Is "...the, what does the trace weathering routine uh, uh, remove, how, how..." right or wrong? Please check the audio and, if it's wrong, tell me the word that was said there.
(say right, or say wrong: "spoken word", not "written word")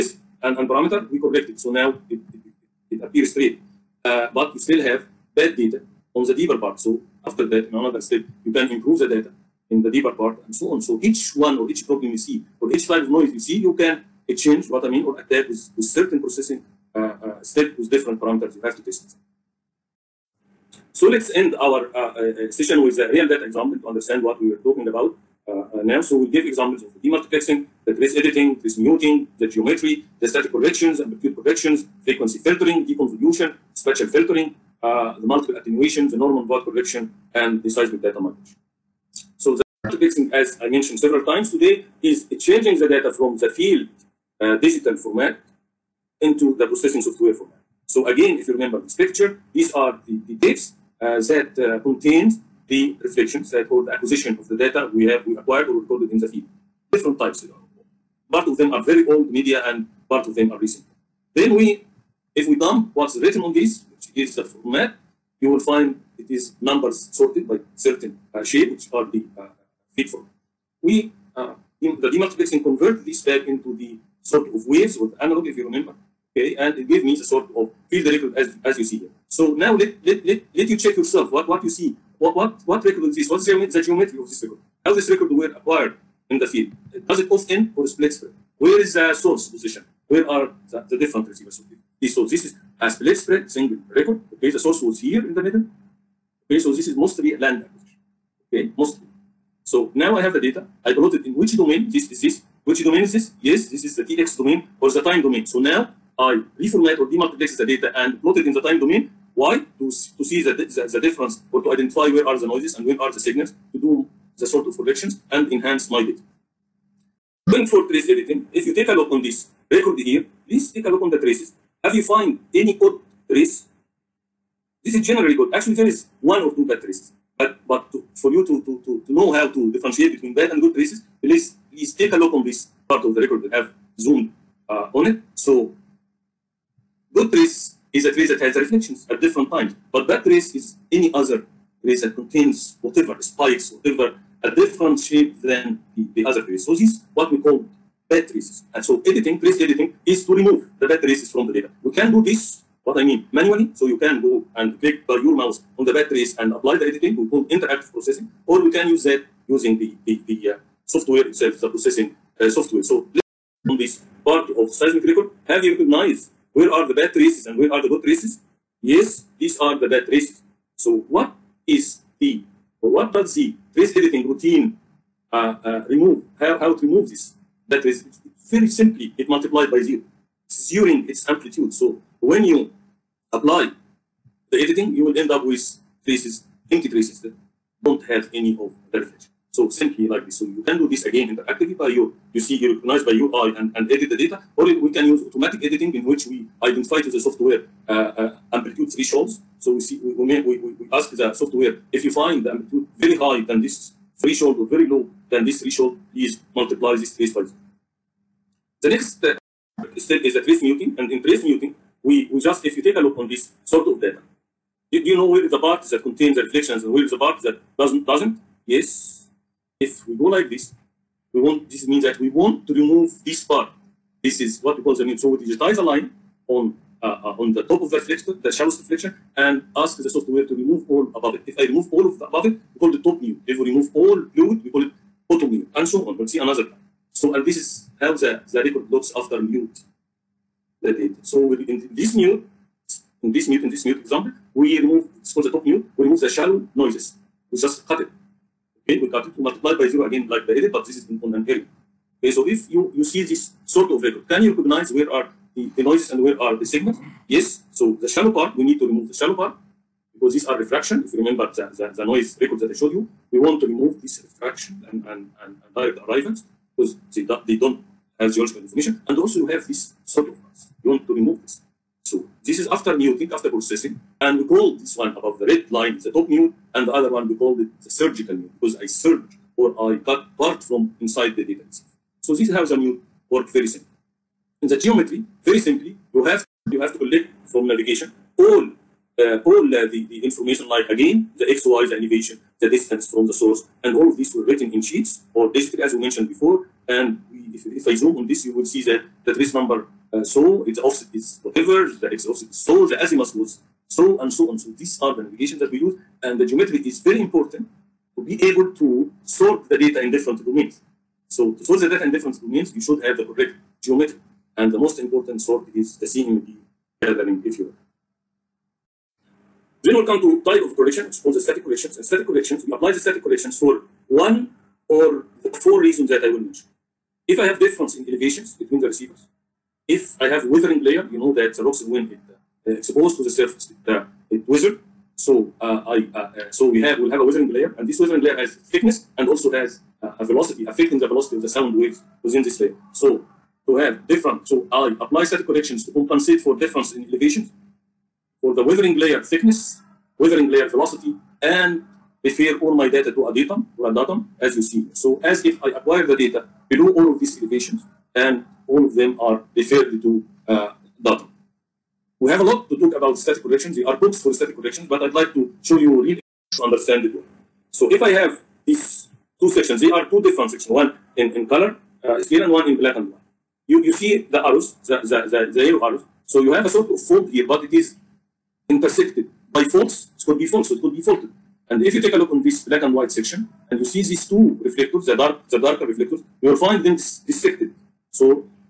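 wrong: "editing", not "weathering".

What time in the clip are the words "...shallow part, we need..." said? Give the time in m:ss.
4:18.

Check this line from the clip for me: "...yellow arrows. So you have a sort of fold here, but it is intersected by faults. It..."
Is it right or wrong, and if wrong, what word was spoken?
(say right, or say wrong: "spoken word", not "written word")
right.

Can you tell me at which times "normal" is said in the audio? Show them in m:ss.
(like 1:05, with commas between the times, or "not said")
0:36.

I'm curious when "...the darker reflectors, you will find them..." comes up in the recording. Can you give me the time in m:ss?
6:25.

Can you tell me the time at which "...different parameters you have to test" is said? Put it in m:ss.
0:17.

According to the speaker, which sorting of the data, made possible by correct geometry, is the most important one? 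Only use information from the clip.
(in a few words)
CMP gathering.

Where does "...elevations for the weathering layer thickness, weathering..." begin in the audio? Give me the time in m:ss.
5:47.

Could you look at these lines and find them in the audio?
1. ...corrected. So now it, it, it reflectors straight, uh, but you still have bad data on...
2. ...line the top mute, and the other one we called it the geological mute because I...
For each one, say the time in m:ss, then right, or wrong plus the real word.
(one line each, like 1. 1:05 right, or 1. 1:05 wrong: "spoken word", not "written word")
1. 0:01 wrong: "appears", not "reflectors"
2. 4:35 wrong: "surgical", not "geological".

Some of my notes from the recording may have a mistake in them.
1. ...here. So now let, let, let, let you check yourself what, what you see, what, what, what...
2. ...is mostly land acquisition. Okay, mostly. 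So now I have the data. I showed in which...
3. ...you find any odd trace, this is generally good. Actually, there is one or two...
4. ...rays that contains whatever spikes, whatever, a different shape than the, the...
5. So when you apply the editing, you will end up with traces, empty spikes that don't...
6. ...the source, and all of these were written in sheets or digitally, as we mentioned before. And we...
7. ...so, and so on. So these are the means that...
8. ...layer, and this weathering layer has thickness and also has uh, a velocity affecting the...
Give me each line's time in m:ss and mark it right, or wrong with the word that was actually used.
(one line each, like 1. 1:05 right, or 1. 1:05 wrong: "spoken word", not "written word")
1. 1:18 right
2. 1:36 wrong: "plotted", not "showed"
3. 2:01 right
4. 2:21 right
5. 3:01 wrong: "traces", not "spikes"
6. 4:53 right
7. 5:03 wrong: "navigations", not "means"
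8. 5:37 right.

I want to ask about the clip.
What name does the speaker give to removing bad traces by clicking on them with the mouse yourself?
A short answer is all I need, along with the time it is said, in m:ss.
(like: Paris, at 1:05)
Interactive processing, at 2:37.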